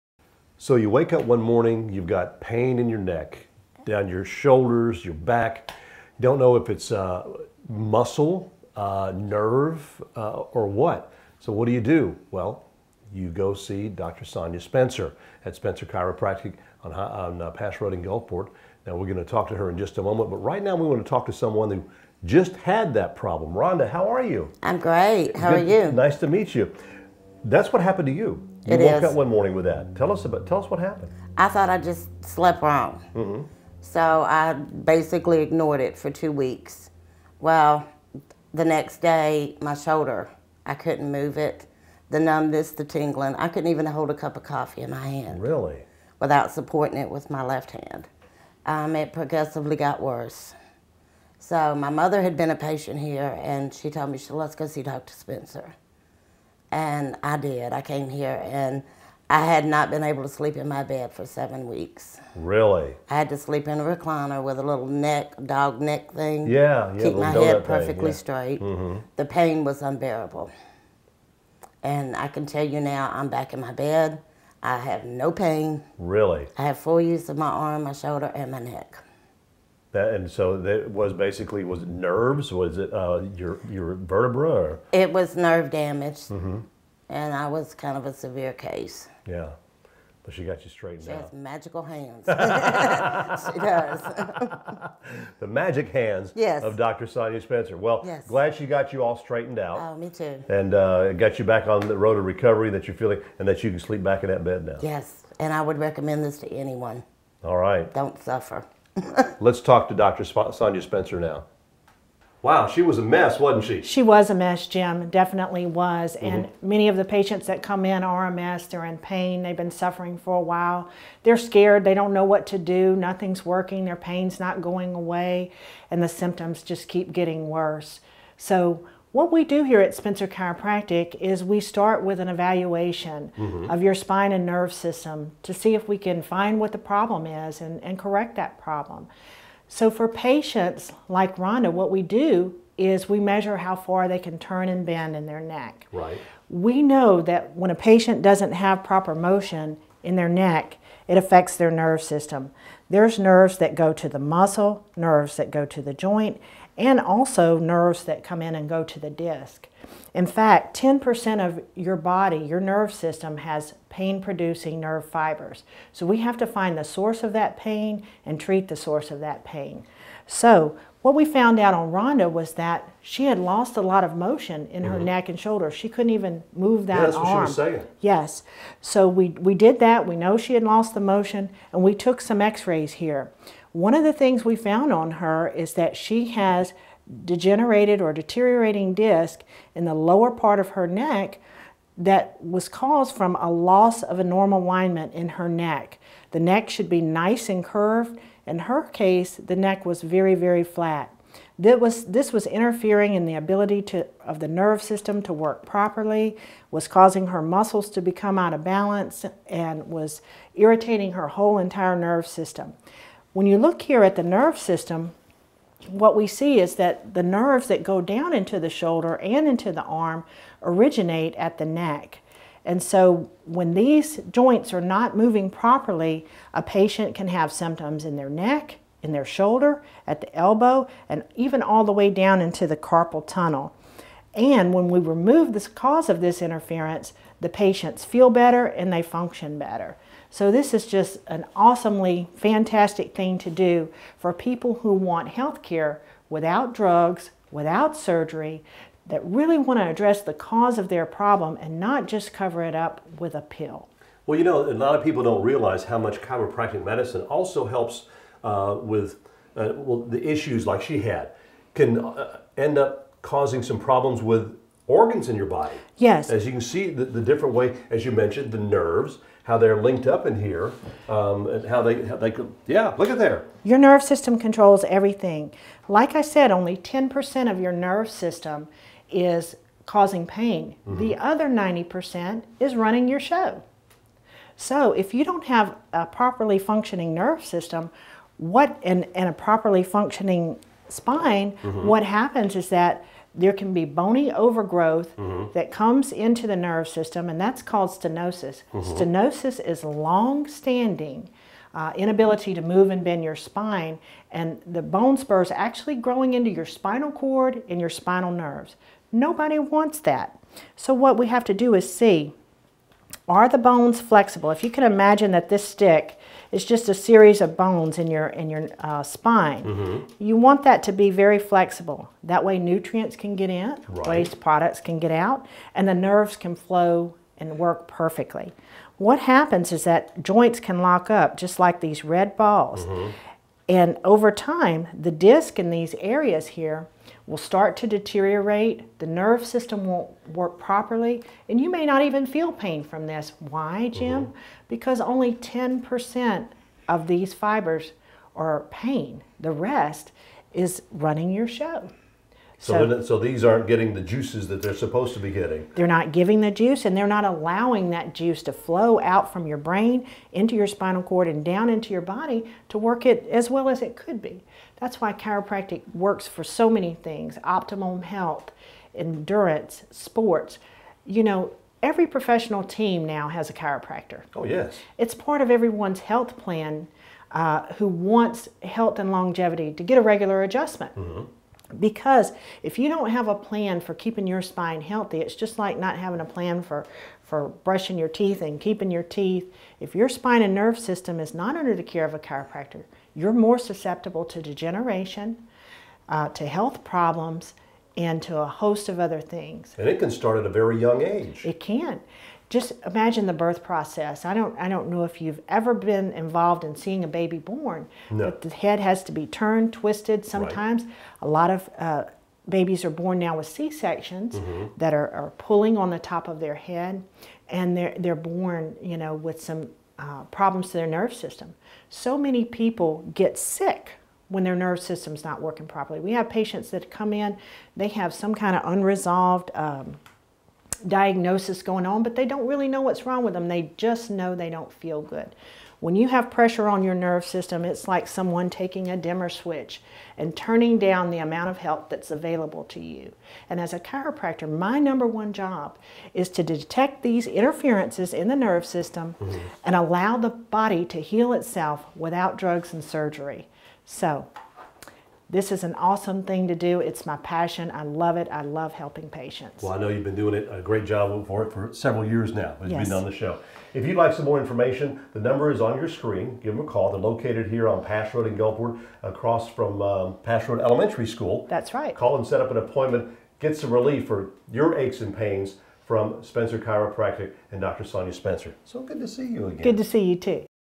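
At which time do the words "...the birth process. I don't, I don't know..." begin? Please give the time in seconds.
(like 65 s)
403 s.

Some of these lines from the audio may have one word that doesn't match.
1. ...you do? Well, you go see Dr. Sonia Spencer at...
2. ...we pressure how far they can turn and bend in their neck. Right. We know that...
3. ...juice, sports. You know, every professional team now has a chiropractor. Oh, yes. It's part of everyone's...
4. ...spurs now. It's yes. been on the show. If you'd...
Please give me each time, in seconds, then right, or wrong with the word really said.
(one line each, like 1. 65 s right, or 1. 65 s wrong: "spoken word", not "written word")
1. 11 s right
2. 143 s wrong: "measure", not "pressure"
3. 368 s wrong: "endurance", not "juice"
4. 462 s wrong: "years", not "spurs".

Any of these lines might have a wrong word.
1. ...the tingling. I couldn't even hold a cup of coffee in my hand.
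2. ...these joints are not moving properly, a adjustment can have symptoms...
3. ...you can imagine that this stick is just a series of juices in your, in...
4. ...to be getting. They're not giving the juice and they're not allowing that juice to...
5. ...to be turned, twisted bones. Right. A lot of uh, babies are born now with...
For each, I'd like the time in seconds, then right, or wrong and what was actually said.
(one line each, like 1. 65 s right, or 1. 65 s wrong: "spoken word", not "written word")
1. 42 s right
2. 223 s wrong: "patient", not "adjustment"
3. 314 s wrong: "bones", not "juices"
4. 355 s right
5. 409 s wrong: "sometimes", not "bones".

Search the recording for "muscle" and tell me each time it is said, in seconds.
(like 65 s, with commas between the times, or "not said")
7 s, 154 s, 207 s.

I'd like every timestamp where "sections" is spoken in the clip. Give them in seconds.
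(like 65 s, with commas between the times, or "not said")
413 s.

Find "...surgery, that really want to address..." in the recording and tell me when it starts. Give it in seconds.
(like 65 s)
247 s.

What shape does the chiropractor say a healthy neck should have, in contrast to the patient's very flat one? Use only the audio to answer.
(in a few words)
curved.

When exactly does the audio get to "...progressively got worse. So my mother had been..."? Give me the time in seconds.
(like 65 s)
49 s.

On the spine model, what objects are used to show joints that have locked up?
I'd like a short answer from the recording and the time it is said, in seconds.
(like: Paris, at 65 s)
red balls, at 332 s.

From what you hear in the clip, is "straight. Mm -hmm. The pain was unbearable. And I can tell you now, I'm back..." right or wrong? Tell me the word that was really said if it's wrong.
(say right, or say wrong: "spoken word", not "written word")
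right.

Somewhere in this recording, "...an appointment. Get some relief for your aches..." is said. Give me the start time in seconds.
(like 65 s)
472 s.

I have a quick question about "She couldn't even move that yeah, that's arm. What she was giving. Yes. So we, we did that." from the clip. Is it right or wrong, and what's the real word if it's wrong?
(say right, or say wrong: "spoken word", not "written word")
wrong: "saying", not "giving".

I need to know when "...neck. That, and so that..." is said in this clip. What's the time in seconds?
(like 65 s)
78 s.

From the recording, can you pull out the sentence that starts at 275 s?
Like I said, only ten percent of your nerve system is causing pain.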